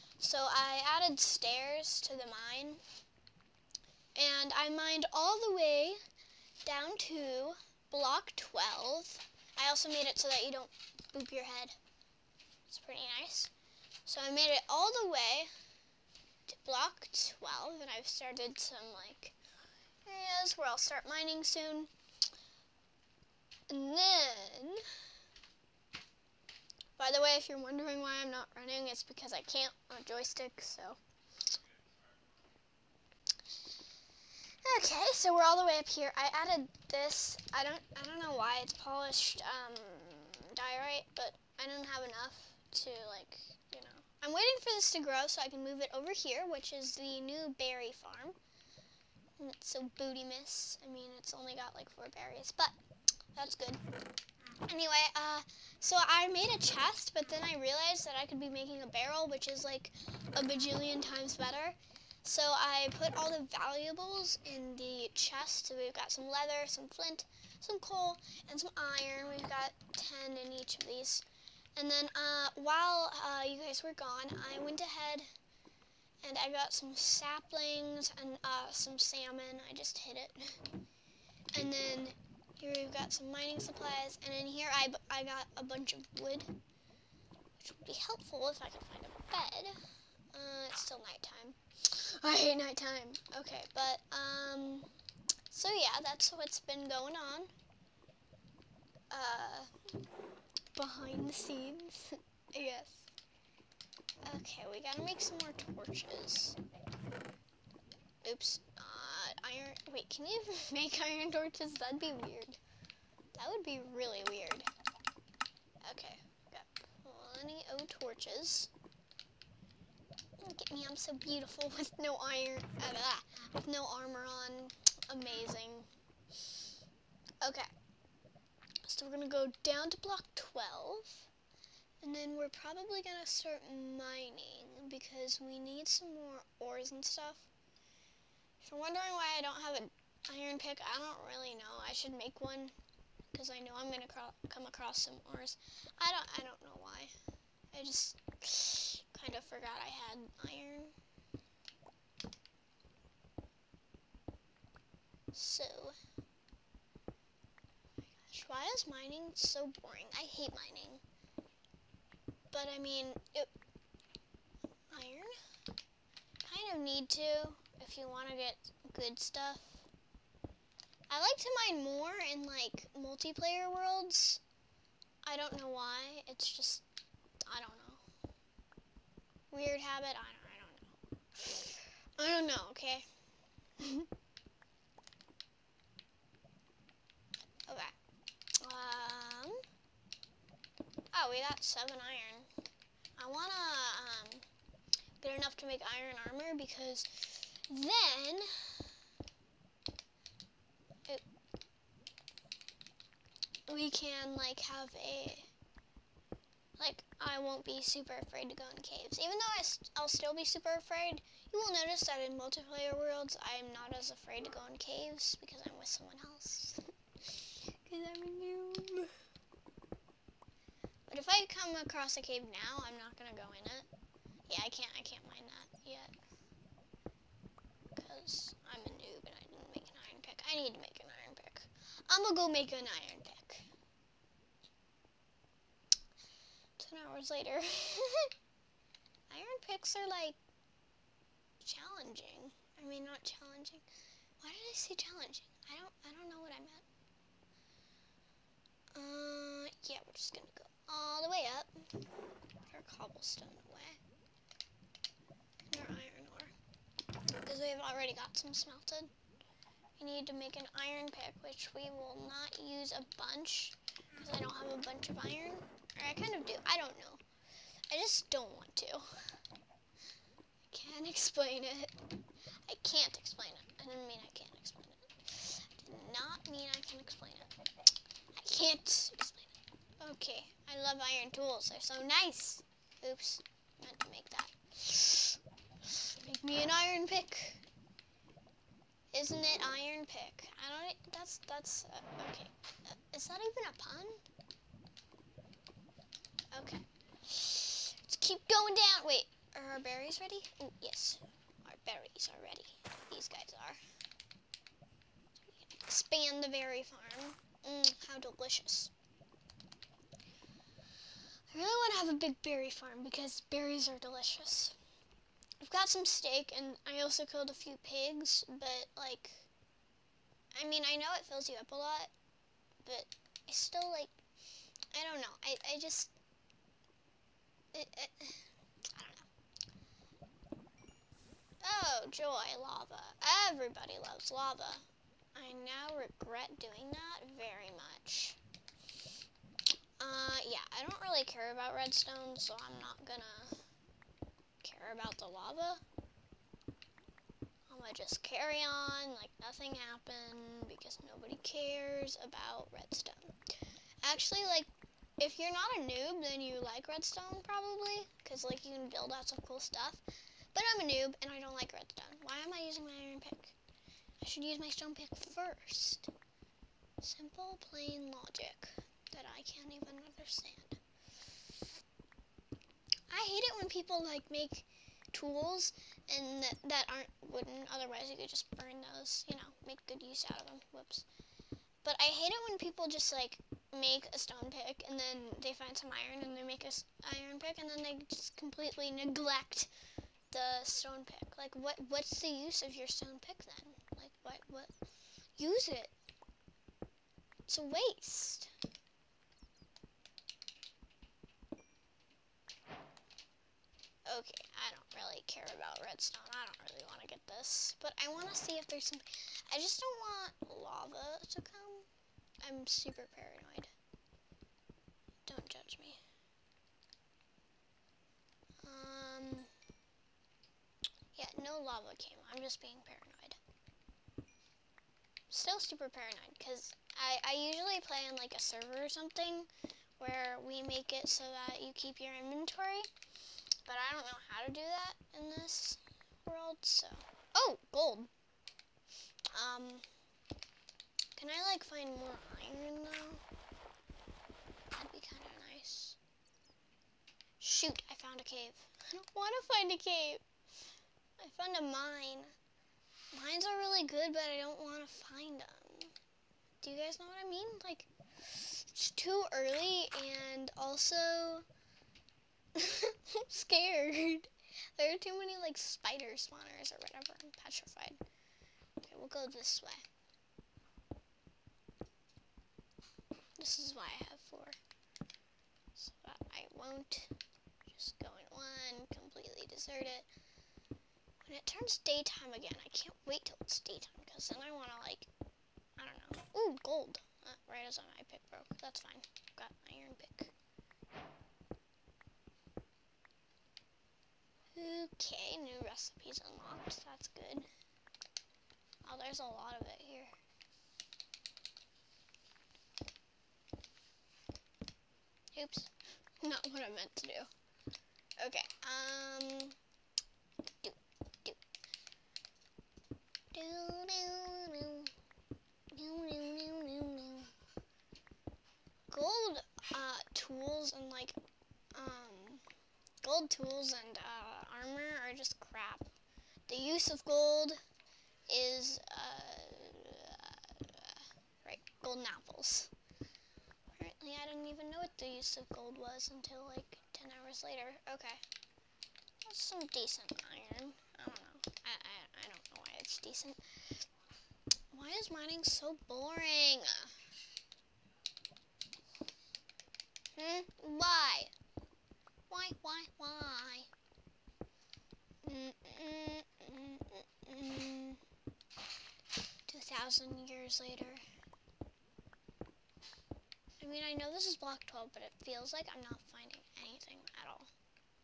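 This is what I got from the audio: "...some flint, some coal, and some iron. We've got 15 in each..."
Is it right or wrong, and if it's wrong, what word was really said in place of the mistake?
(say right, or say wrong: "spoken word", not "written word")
wrong: "10", not "15".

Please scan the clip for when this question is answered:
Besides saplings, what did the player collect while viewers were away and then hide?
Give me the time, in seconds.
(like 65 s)
78 s.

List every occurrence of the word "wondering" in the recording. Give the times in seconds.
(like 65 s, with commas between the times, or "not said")
27 s, 138 s.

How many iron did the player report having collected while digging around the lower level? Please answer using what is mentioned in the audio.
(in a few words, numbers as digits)
7.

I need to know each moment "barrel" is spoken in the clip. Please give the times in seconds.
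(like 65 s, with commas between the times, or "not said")
58 s.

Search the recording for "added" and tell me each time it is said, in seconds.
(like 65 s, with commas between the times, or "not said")
0 s, 36 s.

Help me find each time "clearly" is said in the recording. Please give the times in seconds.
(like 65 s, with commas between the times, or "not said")
not said.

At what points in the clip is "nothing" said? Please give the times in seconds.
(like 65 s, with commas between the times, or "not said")
349 s.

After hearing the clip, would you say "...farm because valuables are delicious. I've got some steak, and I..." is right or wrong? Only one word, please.
wrong.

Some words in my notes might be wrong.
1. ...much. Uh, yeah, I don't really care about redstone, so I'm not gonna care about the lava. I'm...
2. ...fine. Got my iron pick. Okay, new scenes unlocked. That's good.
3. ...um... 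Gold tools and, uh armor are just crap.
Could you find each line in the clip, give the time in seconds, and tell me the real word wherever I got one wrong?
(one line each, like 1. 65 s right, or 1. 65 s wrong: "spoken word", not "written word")
1. 337 s right
2. 488 s wrong: "recipes", not "scenes"
3. 521 s right.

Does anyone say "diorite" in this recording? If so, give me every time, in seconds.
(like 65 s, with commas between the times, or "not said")
40 s.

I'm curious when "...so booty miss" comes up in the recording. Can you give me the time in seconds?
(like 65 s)
49 s.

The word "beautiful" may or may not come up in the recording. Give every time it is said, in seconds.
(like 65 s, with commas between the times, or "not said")
121 s.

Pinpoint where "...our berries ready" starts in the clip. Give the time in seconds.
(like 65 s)
299 s.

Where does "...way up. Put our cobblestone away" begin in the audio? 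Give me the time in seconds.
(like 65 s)
251 s.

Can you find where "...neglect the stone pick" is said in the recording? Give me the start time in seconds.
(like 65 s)
388 s.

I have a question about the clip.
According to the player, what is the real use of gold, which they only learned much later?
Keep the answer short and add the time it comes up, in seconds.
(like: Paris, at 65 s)
golden apples, at 531 s.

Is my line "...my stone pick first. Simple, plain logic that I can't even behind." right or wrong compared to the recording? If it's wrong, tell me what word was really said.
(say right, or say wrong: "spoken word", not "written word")
wrong: "understand", not "behind".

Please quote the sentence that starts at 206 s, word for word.
Like, I won't be super afraid to go in caves.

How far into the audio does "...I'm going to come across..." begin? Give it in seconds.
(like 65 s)
143 s.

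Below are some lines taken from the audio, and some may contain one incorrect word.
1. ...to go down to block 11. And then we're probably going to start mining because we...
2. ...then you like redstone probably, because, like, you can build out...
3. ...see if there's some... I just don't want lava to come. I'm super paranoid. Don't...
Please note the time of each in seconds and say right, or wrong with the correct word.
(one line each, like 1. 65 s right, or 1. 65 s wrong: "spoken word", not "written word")
1. 129 s wrong: "12", not "11"
2. 356 s right
3. 408 s right.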